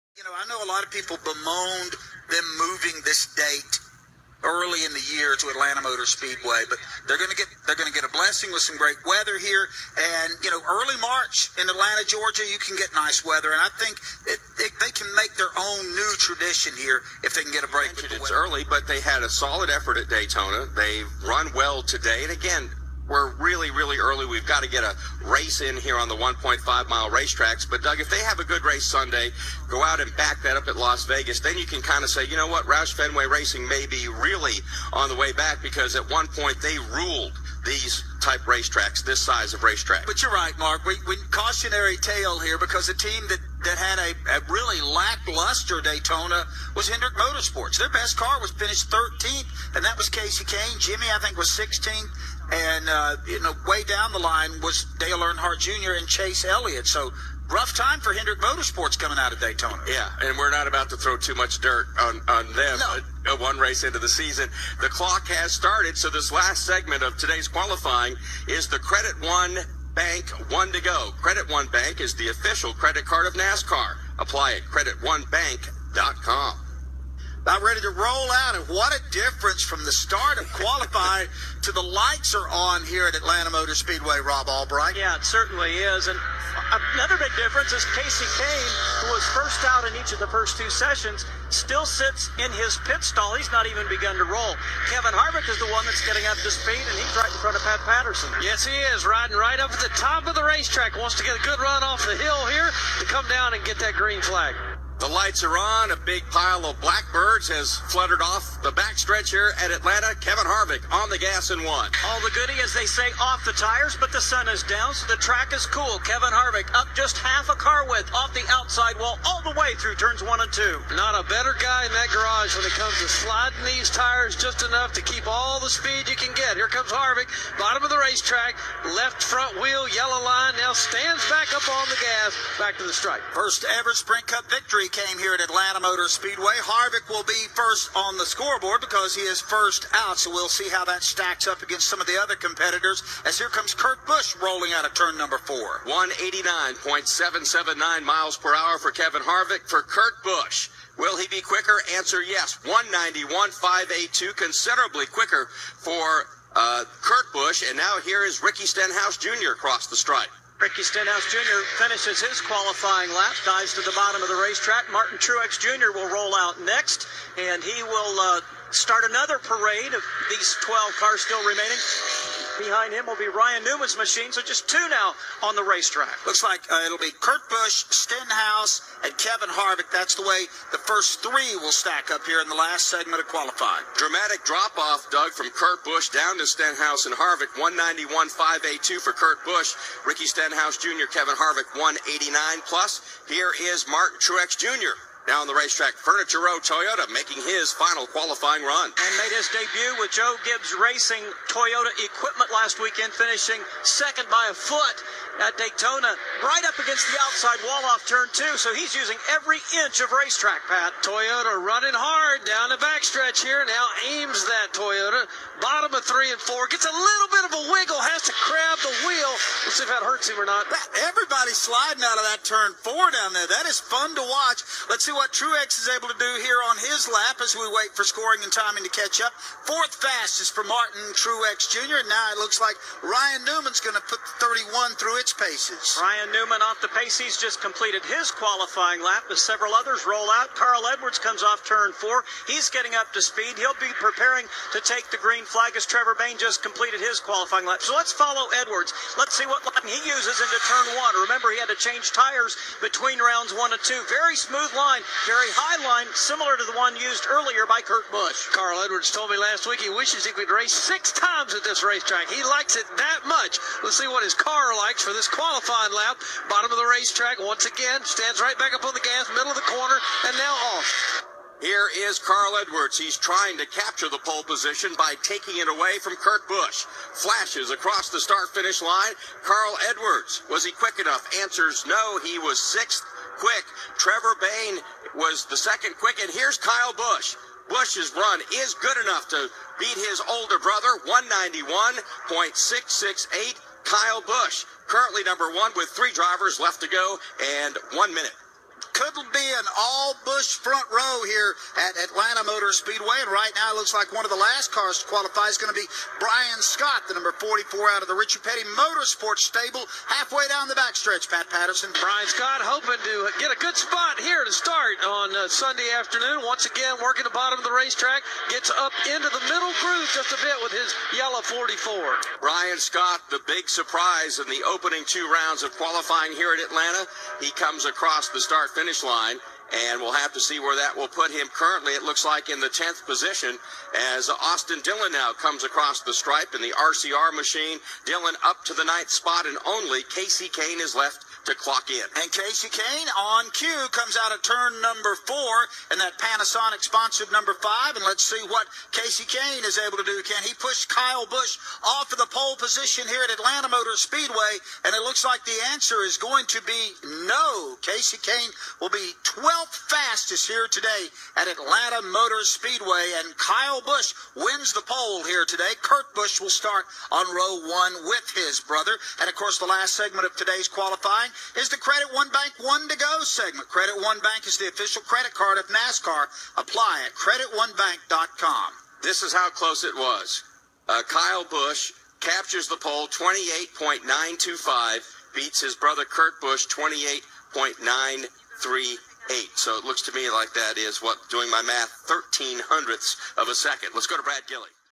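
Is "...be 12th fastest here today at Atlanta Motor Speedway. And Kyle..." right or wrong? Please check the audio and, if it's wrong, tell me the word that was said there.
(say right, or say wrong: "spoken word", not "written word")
right.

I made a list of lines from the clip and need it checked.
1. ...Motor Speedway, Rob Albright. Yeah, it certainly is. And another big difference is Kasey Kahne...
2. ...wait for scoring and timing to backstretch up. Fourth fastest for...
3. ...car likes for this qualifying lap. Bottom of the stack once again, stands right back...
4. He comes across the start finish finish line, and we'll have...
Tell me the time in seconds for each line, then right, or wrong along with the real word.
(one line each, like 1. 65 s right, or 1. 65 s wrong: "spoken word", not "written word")
1. 83 s right
2. 227 s wrong: "catch", not "backstretch"
3. 264 s wrong: "racetrack", not "stack"
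4. 327 s right.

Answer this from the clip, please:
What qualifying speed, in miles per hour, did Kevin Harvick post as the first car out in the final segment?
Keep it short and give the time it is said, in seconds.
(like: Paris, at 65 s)
189.779, at 145 s.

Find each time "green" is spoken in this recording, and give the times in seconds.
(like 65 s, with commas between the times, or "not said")
103 s, 245 s.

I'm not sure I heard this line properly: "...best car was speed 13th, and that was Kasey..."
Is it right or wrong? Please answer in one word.
wrong.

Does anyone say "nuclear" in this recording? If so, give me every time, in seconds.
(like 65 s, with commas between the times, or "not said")
not said.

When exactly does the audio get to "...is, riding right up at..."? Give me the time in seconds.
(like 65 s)
98 s.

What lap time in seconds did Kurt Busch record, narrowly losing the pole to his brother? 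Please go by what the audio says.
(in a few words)
28.938.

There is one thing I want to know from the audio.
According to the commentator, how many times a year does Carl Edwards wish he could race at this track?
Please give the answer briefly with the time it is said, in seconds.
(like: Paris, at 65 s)
6, at 260 s.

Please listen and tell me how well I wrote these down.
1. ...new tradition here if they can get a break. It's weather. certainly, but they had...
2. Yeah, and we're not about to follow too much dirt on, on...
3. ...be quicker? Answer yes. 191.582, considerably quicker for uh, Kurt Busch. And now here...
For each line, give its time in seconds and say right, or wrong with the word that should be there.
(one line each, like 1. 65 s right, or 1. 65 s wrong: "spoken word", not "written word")
1. 15 s wrong: "early", not "certainly"
2. 59 s wrong: "throw", not "follow"
3. 151 s right.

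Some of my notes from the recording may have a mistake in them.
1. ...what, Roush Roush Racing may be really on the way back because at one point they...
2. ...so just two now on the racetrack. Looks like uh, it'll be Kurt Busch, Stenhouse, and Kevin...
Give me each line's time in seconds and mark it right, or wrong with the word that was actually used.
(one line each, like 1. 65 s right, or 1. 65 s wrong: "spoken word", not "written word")
1. 32 s wrong: "Fenway", not "Roush"
2. 174 s right.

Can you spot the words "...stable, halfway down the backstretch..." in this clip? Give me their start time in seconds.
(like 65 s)
309 s.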